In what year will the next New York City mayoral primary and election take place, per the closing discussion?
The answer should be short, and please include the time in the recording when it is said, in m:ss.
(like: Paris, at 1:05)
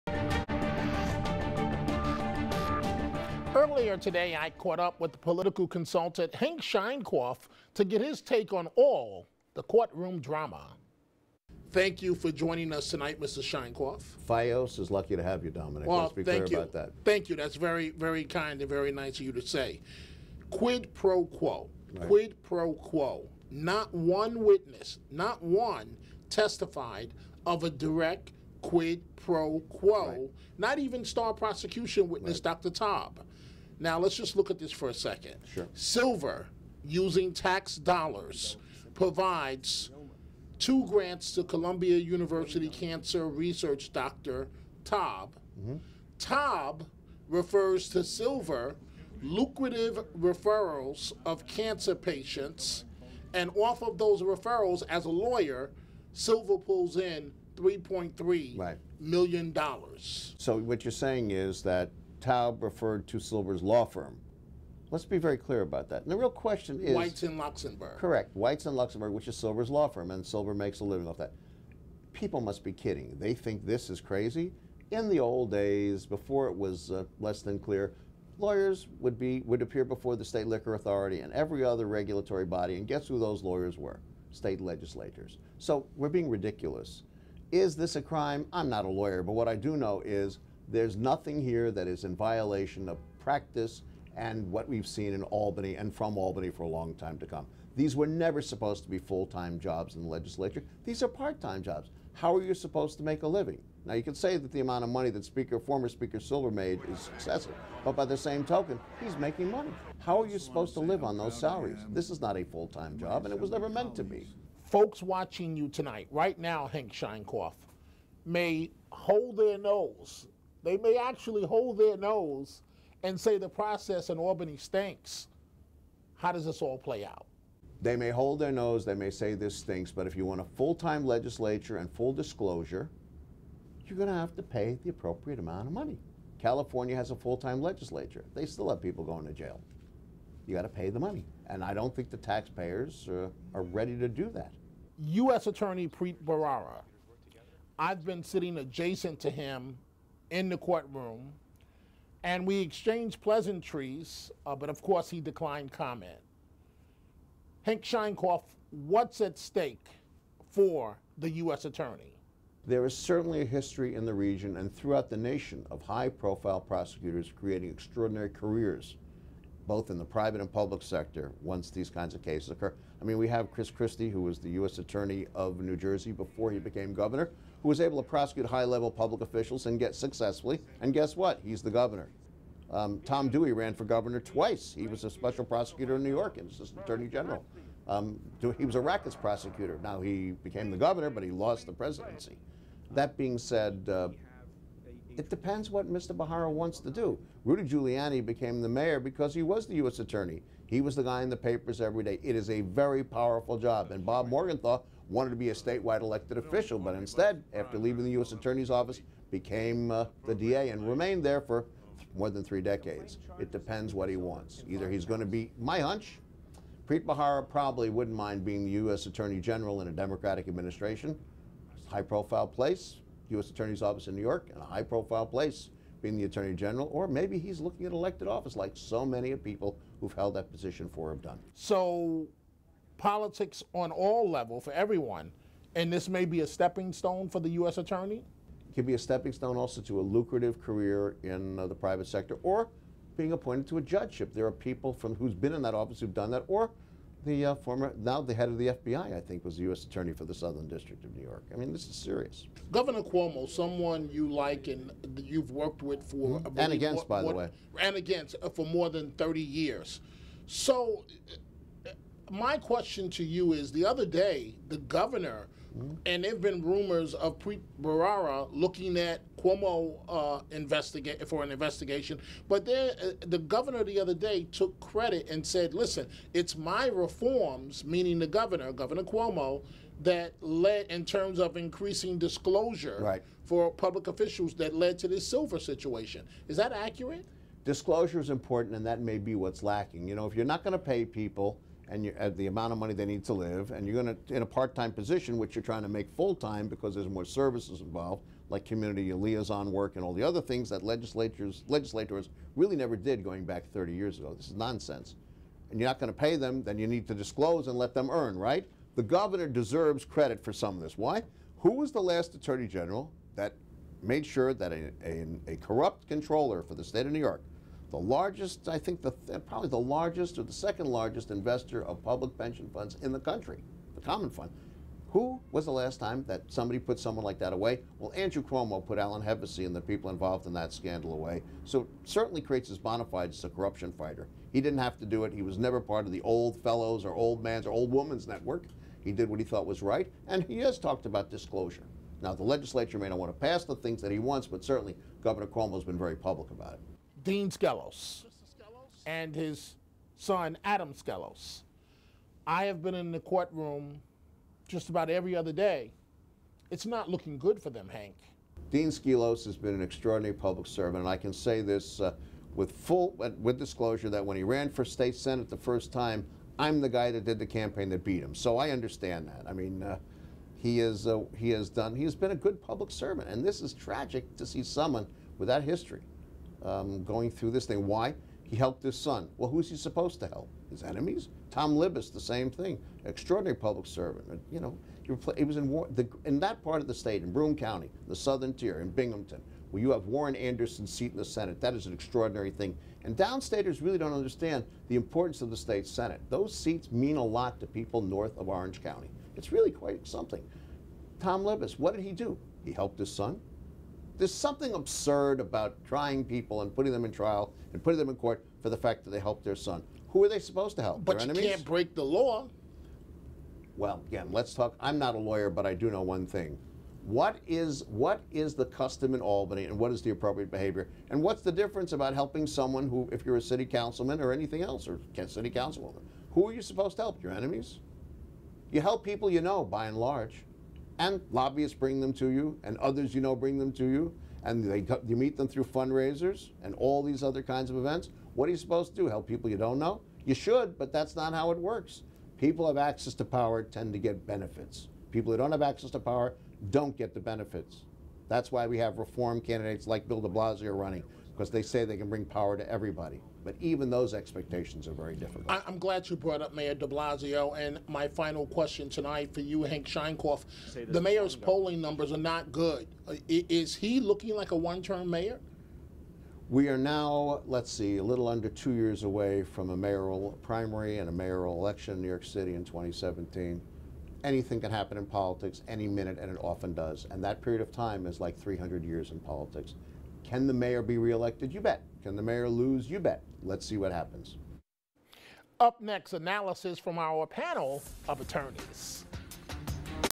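2017, at 7:52.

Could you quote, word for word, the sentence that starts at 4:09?
Attorney for the Southern District of New York.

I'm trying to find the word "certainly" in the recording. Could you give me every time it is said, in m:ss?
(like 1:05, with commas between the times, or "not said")
2:42, 5:32, 5:44.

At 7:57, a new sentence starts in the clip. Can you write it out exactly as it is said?
And that period of time is like 300 years in politics.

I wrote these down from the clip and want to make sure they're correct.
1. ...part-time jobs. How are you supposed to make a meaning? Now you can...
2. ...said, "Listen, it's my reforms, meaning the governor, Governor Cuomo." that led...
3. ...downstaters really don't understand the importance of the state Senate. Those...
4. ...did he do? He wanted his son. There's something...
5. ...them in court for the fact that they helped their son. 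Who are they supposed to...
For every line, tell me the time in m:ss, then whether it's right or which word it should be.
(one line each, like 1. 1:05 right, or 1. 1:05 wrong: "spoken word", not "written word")
1. 1:41 wrong: "living", not "meaning"
2. 4:35 right
3. 6:33 right
4. 6:41 wrong: "helped", not "wanted"
5. 6:47 right.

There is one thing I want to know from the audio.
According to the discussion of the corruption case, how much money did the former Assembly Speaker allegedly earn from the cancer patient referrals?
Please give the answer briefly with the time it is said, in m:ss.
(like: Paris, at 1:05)
$3.3 million, at 0:57.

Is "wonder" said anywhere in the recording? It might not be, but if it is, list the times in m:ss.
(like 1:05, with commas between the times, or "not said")
not said.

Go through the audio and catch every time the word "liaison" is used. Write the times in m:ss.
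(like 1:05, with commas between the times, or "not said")
4:59.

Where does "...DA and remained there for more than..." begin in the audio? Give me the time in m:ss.
3:30.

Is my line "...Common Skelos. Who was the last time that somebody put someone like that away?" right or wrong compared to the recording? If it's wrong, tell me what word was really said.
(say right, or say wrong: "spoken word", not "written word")
wrong: "Fund", not "Skelos".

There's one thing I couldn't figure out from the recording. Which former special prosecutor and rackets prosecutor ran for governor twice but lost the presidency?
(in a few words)
Tom Dewey.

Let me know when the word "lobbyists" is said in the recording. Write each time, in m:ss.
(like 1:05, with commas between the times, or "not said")
7:11.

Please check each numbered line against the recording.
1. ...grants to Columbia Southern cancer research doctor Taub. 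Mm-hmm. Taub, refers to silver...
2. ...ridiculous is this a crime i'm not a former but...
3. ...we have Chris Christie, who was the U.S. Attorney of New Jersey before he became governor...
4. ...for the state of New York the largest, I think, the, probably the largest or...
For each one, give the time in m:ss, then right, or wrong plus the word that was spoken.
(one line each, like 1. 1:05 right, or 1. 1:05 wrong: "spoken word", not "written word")
1. 0:40 wrong: "University", not "Southern"
2. 1:26 wrong: "lawyer", not "former"
3. 2:53 right
4. 5:16 right.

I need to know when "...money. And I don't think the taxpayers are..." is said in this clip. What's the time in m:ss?
2:20.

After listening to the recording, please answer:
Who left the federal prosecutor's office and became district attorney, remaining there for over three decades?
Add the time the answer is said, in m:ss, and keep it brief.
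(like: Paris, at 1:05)
Bob Morgenthau, at 3:24.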